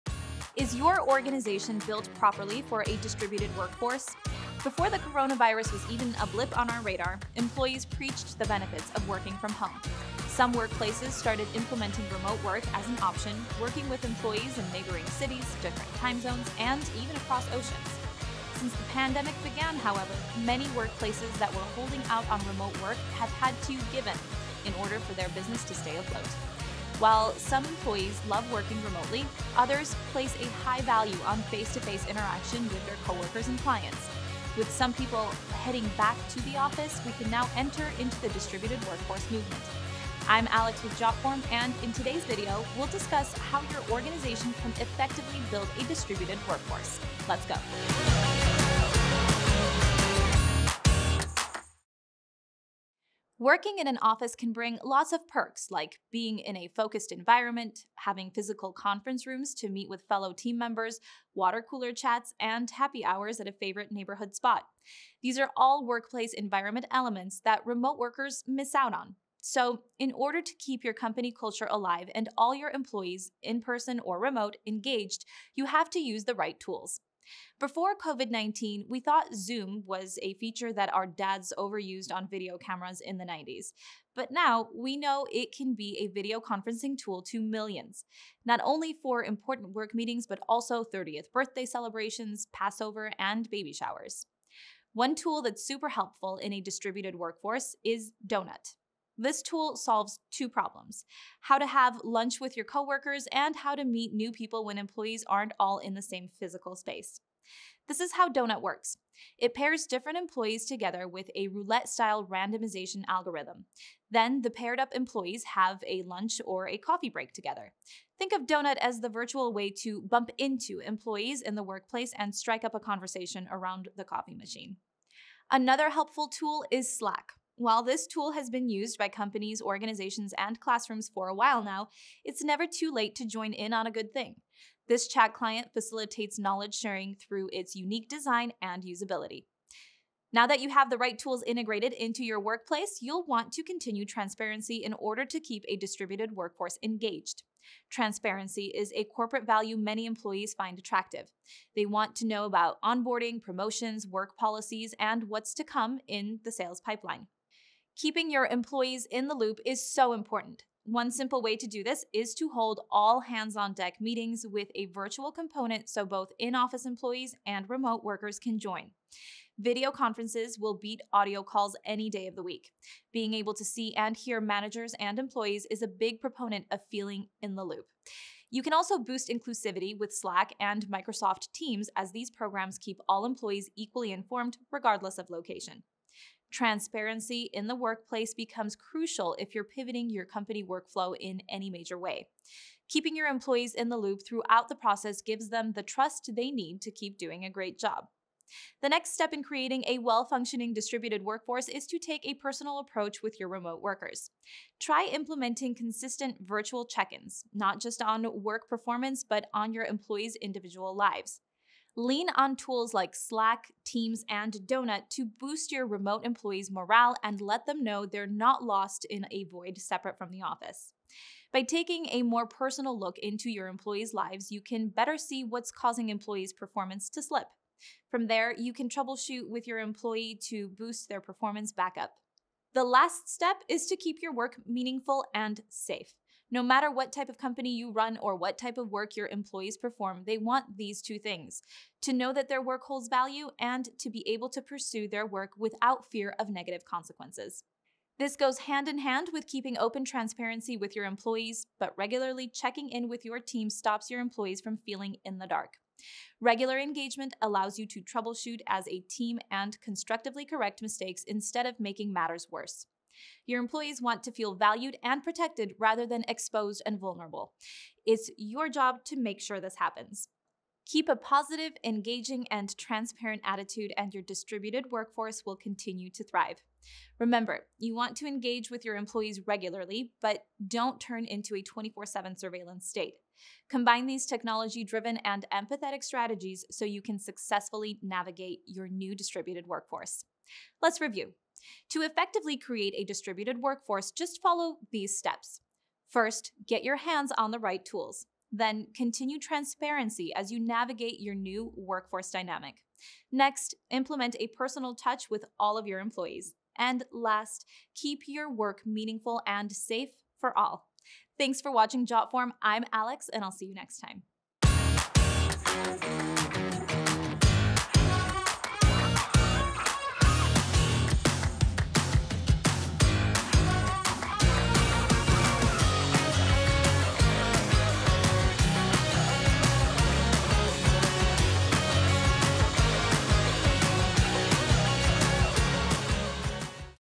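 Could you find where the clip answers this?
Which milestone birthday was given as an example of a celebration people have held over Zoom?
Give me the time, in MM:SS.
01:30.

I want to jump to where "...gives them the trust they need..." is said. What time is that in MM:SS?
03:15.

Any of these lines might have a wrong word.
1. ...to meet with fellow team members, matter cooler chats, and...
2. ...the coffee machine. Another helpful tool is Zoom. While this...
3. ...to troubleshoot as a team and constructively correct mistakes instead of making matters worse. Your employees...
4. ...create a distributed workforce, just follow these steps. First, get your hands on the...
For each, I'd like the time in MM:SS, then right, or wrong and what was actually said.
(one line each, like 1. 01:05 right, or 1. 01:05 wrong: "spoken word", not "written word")
1. 00:59 wrong: "water", not "matter"
2. 02:03 wrong: "Slack", not "Zoom"
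3. 04:17 right
4. 04:52 right.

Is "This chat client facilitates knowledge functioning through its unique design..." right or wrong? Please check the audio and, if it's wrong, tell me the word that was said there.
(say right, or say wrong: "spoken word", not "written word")
wrong: "sharing", not "functioning".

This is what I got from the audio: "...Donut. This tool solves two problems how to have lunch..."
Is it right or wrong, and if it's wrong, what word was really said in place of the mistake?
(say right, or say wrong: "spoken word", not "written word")
right.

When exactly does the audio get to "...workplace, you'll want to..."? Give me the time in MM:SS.
02:22.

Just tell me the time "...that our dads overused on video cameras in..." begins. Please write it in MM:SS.
01:20.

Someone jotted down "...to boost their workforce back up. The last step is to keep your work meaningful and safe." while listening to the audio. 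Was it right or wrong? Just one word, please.
wrong.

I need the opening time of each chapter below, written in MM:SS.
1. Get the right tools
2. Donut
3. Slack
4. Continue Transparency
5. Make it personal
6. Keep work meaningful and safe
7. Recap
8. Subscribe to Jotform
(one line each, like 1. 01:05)
1. 00:53
2. 01:37
3. 02:05
4. 02:22
5. 03:21
6. 03:52
7. 04:51
8. 05:13.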